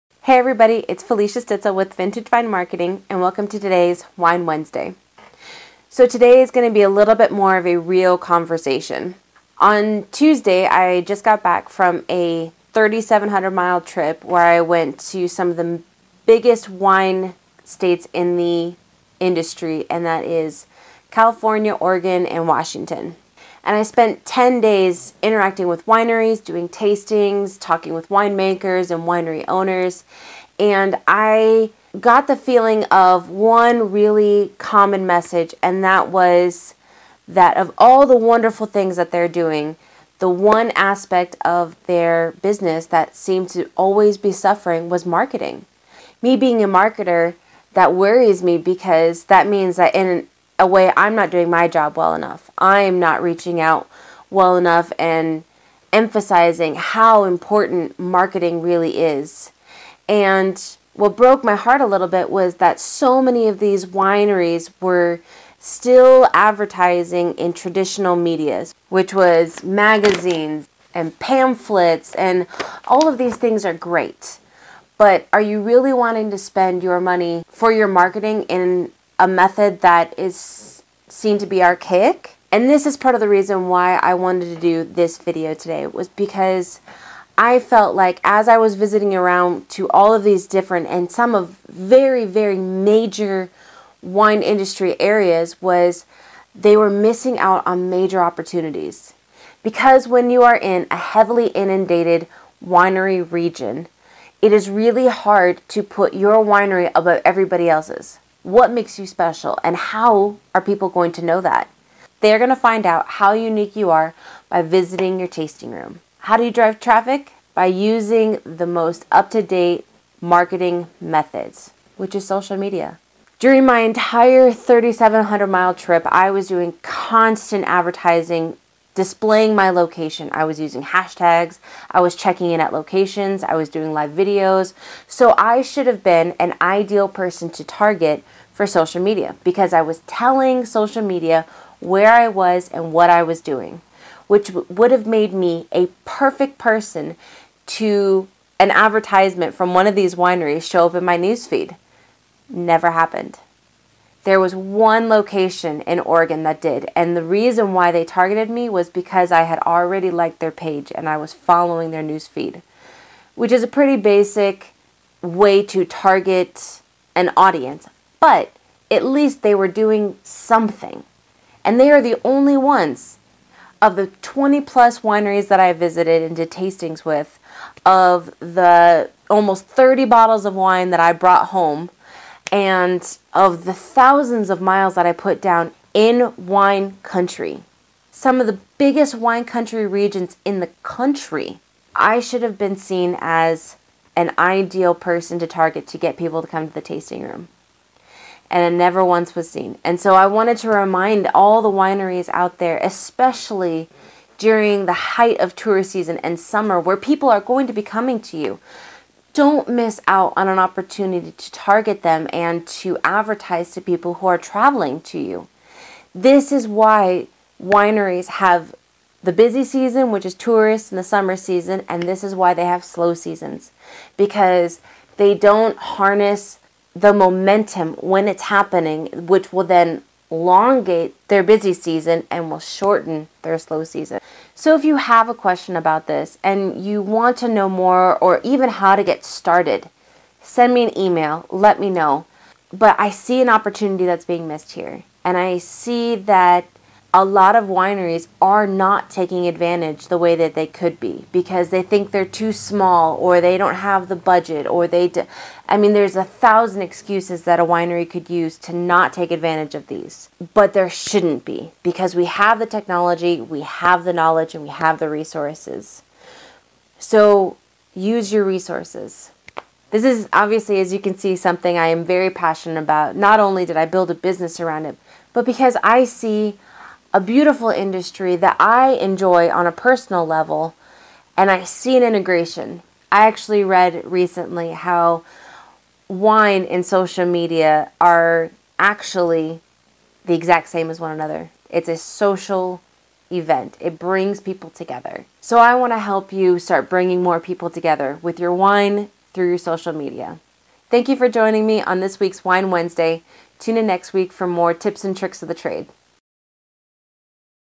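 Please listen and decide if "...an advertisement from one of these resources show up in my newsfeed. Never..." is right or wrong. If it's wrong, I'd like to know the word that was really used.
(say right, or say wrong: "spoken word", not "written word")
wrong: "wineries", not "resources".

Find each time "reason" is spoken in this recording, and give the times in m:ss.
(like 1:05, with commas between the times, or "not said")
1:23, 2:37.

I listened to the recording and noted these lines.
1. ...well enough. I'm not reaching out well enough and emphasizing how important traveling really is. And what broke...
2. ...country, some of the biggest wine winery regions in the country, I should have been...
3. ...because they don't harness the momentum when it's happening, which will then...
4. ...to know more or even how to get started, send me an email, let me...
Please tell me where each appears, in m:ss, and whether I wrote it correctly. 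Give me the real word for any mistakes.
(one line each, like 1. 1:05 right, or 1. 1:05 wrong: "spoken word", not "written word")
1. 0:51 wrong: "marketing", not "traveling"
2. 3:07 wrong: "country", not "winery"
3. 3:44 right
4. 3:57 right.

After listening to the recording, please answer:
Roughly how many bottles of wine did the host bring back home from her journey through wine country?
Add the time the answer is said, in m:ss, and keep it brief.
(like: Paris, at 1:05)
30, at 2:59.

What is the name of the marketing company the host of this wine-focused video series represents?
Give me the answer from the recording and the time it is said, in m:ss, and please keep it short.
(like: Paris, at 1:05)
Vintage Vine Marketing, at 0:01.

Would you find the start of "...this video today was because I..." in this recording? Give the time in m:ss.
1:24.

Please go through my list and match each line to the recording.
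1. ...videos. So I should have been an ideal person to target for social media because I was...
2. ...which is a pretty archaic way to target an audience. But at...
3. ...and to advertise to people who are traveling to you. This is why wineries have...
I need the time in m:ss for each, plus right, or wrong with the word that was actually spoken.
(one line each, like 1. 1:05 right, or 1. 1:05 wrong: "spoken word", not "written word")
1. 2:14 right
2. 2:43 wrong: "basic", not "archaic"
3. 3:32 right.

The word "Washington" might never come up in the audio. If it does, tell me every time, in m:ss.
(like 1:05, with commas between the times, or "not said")
0:22.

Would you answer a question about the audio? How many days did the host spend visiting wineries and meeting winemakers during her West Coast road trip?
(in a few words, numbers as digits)
10.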